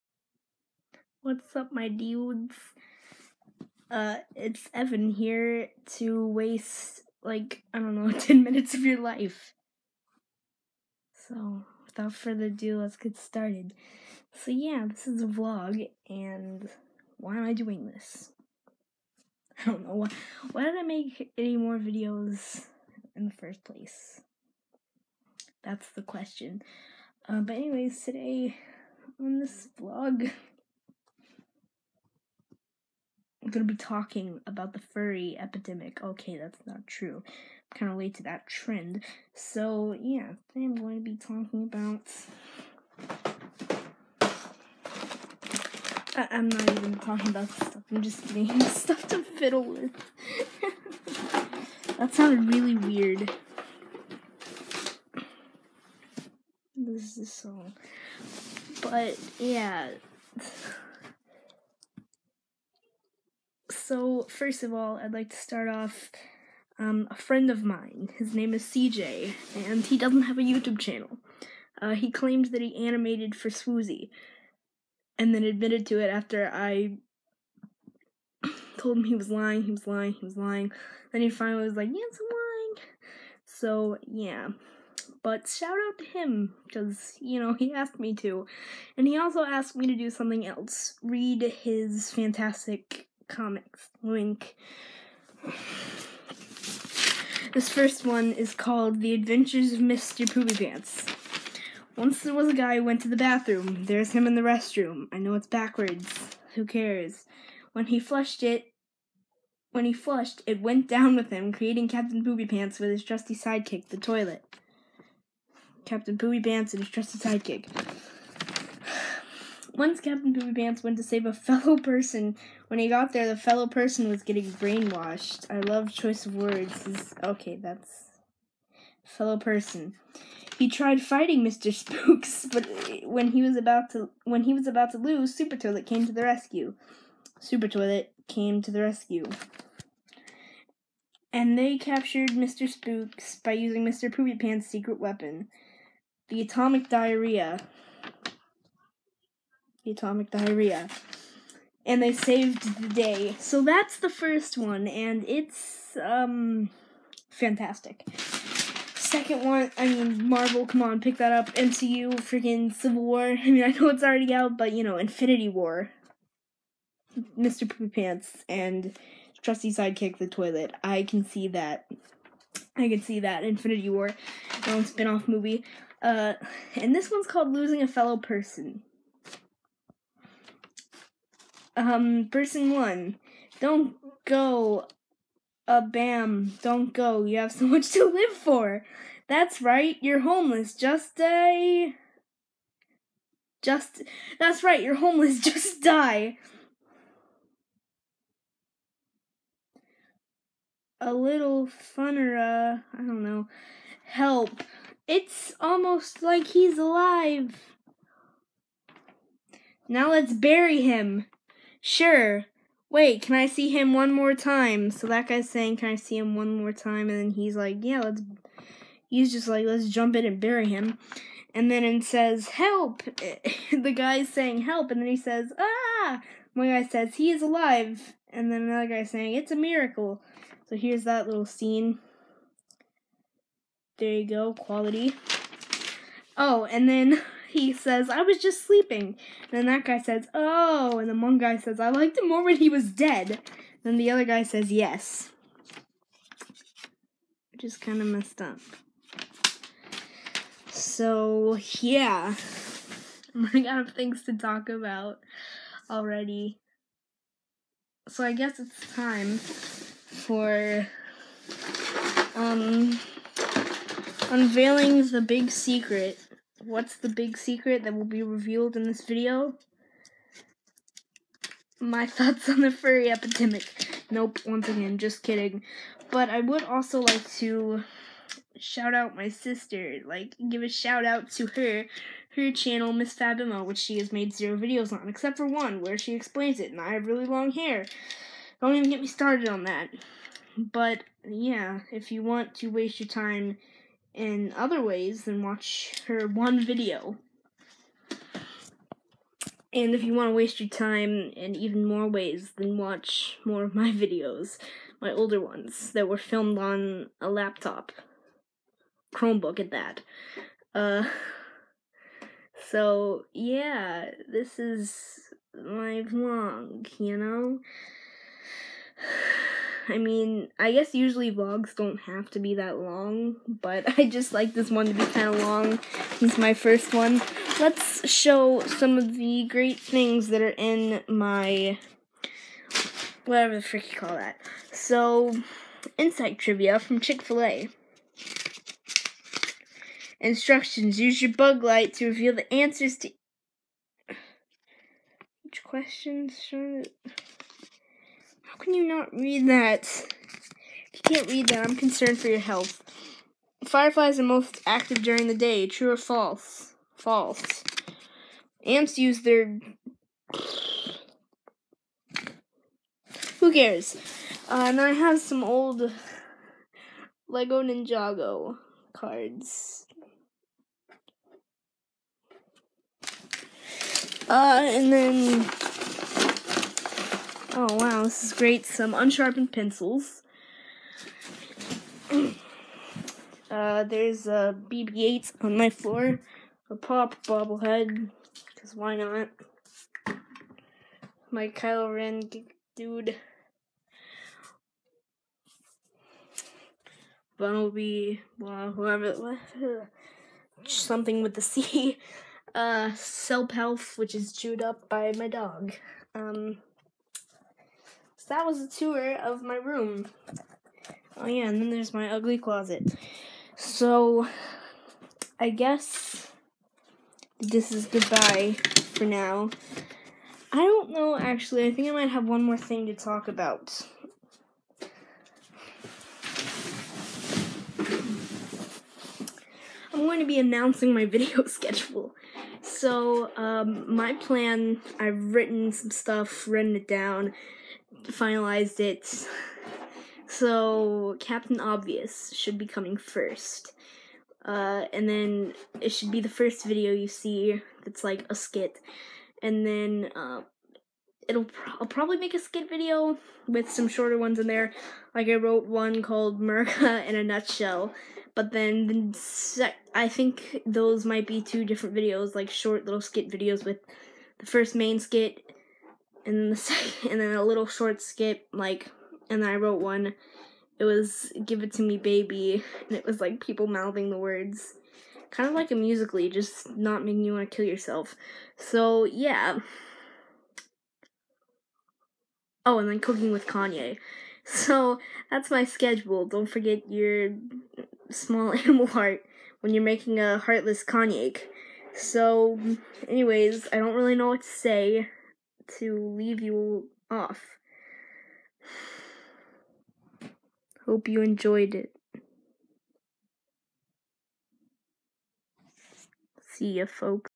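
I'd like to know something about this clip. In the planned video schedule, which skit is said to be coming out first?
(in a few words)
Captain Obvious.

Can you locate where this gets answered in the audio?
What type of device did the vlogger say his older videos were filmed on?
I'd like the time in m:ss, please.
5:09.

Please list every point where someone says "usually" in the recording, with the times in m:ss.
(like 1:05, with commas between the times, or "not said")
5:20.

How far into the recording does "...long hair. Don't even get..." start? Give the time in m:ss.
4:47.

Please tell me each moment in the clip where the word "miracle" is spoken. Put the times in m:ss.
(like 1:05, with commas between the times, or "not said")
3:49.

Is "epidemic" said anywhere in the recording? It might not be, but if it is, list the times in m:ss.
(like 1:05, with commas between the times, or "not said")
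0:35, 4:33.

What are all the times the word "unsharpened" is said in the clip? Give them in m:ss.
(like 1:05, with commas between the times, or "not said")
6:18.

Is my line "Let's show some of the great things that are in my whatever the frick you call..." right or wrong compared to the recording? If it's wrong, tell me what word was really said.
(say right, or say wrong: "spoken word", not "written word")
right.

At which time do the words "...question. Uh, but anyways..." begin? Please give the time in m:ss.
0:26.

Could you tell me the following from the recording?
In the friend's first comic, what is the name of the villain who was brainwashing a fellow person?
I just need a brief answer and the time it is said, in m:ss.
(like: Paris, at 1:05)
Mr. Spooks, at 2:11.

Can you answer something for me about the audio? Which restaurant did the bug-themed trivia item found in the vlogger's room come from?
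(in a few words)
Chick-fil-A.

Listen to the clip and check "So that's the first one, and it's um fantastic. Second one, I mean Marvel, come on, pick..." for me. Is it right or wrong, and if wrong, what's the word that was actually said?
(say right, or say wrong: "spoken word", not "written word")
right.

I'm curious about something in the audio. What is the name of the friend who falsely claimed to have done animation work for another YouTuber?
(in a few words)
CJ.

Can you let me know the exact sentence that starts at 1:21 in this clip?
Then he finally was like, Yes, I'm lying.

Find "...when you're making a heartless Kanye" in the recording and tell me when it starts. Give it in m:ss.
8:09.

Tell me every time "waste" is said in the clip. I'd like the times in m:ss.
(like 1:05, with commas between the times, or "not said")
0:06, 4:52, 5:00.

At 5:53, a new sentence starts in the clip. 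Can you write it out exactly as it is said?
Fireflies are most active during the day.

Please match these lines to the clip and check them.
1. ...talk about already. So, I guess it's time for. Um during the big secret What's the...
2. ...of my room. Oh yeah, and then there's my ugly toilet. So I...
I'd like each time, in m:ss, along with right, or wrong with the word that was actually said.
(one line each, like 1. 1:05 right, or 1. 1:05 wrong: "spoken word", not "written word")
1. 4:14 wrong: "unveiling", not "during"
2. 6:49 wrong: "closet", not "toilet".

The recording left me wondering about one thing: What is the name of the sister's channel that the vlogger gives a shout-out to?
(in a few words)
Miss Fabimo.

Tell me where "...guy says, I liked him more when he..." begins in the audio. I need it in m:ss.
4:01.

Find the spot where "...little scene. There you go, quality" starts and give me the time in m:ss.
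3:51.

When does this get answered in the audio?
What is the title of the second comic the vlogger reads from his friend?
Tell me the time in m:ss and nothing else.
2:57.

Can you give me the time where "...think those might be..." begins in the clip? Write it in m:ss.
7:40.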